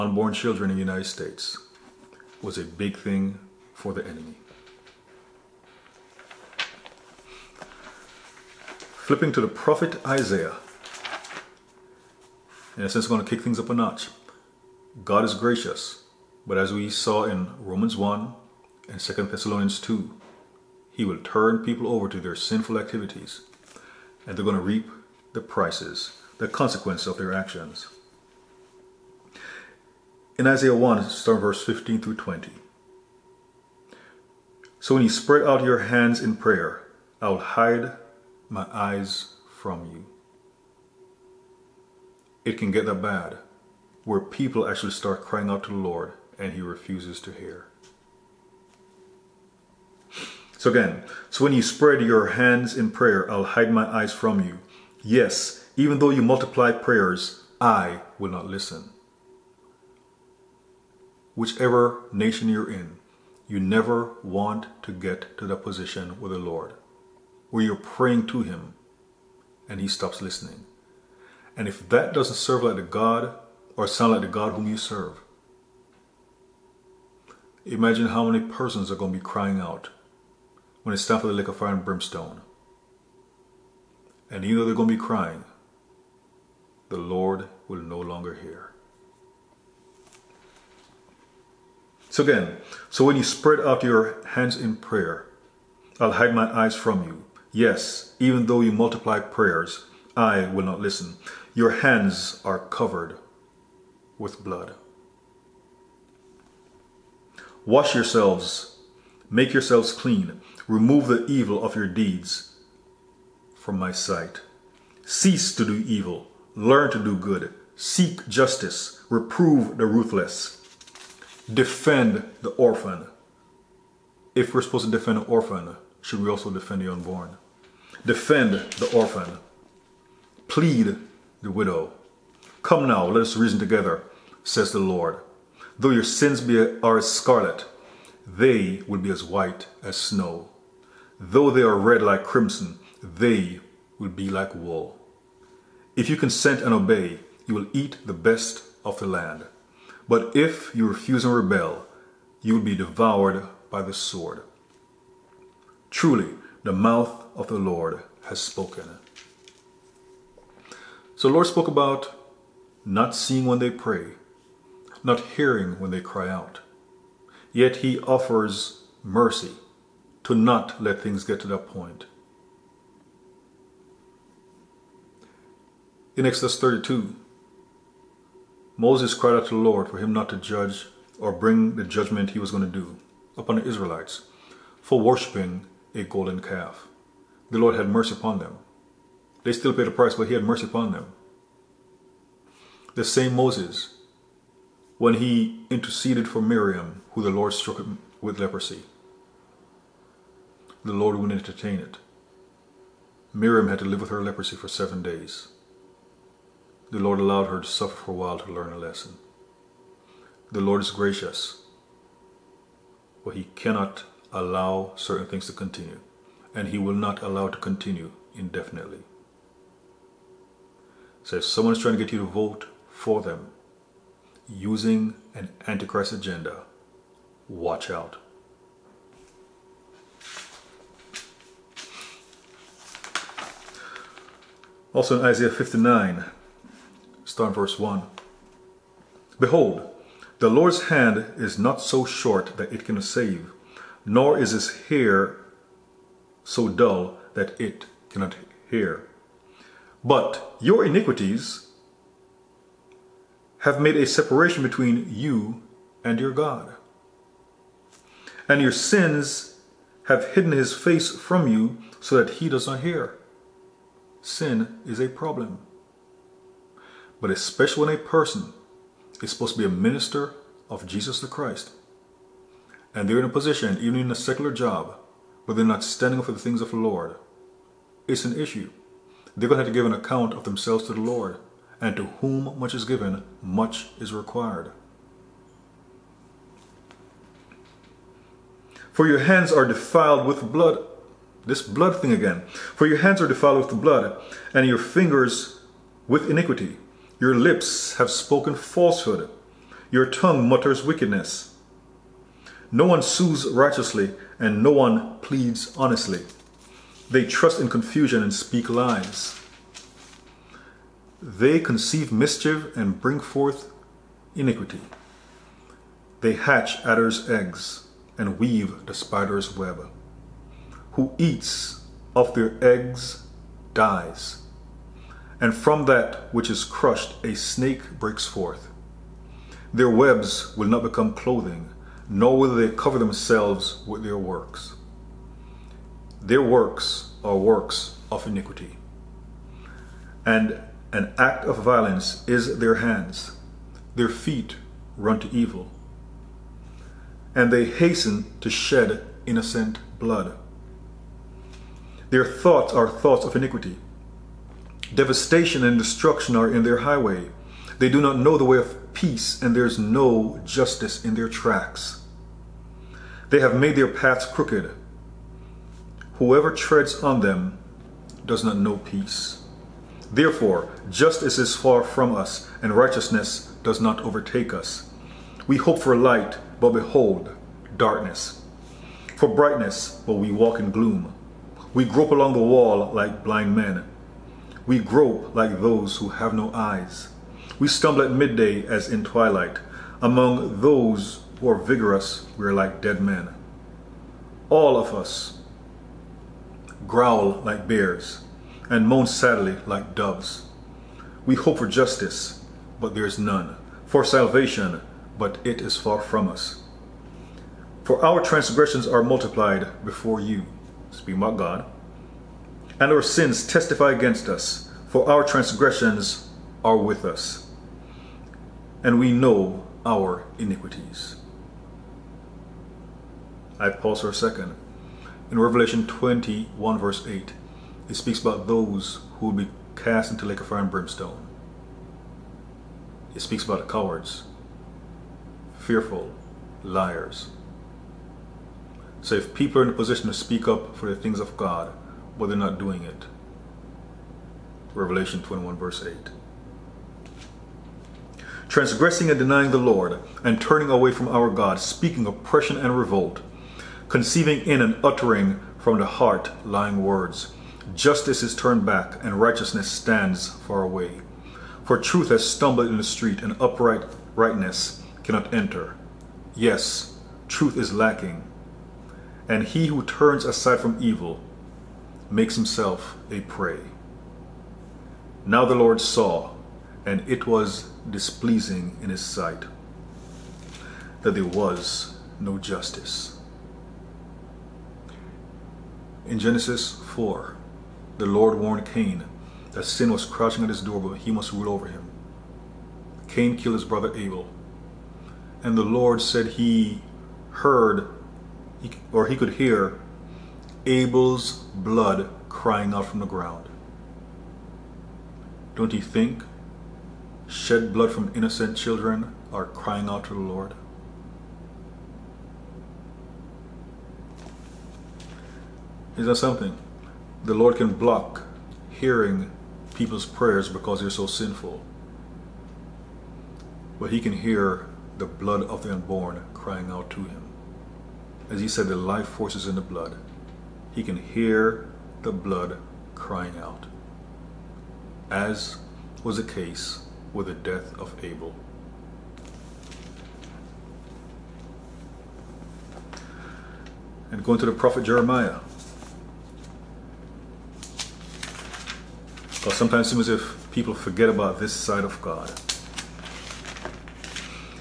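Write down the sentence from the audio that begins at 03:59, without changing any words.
Behold, the Lord's hand is not so short that it can save, nor is his hair so dull that it cannot hear.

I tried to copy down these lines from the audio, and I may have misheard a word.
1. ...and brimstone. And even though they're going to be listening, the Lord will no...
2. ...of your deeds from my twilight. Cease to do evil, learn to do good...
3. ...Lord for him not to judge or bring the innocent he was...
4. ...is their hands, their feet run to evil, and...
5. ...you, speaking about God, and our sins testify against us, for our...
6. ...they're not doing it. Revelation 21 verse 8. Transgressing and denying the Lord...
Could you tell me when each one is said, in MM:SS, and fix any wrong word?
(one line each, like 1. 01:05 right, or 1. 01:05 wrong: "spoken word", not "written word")
1. 01:21 wrong: "crying", not "listening"
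2. 01:51 wrong: "sight", not "twilight"
3. 02:59 wrong: "judgment", not "innocent"
4. 05:42 right
5. 06:50 right
6. 07:22 right.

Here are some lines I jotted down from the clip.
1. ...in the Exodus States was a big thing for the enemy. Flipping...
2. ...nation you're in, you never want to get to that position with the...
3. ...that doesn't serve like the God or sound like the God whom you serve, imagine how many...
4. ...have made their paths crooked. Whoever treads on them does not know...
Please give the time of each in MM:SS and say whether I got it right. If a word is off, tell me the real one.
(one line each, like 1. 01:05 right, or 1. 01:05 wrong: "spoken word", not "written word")
1. 00:00 wrong: "United", not "Exodus"
2. 01:02 right
3. 01:11 right
4. 06:03 right.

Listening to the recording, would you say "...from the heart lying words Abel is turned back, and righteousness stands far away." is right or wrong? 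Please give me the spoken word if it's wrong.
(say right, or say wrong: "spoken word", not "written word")
wrong: "Justice", not "Abel".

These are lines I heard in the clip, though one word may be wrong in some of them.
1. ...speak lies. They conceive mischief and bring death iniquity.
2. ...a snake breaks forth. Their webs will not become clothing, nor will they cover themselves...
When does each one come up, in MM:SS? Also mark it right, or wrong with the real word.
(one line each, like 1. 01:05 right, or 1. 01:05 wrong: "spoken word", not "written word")
1. 05:08 wrong: "forth", not "death"
2. 05:27 right.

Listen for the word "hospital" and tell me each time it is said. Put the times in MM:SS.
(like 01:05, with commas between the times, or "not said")
not said.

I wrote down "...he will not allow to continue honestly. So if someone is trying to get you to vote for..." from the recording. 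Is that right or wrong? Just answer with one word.
wrong.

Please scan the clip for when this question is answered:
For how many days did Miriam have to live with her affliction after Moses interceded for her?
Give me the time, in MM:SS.
03:24.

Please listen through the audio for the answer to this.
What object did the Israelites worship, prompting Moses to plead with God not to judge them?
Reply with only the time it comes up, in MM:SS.
03:06.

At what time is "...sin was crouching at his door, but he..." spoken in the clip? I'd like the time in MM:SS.
08:09.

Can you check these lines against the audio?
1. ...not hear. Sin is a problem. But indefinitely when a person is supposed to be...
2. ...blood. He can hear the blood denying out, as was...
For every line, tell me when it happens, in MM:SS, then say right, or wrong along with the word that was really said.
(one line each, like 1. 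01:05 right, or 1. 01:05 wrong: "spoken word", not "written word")
1. 04:22 wrong: "especially", not "indefinitely"
2. 08:49 wrong: "crying", not "denying".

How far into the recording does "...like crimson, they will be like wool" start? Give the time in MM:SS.
02:22.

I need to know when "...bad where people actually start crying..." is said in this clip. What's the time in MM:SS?
00:43.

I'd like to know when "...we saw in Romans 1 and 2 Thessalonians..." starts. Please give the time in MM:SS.
00:16.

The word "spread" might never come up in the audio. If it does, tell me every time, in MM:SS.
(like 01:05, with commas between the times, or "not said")
00:35, 00:51, 01:33.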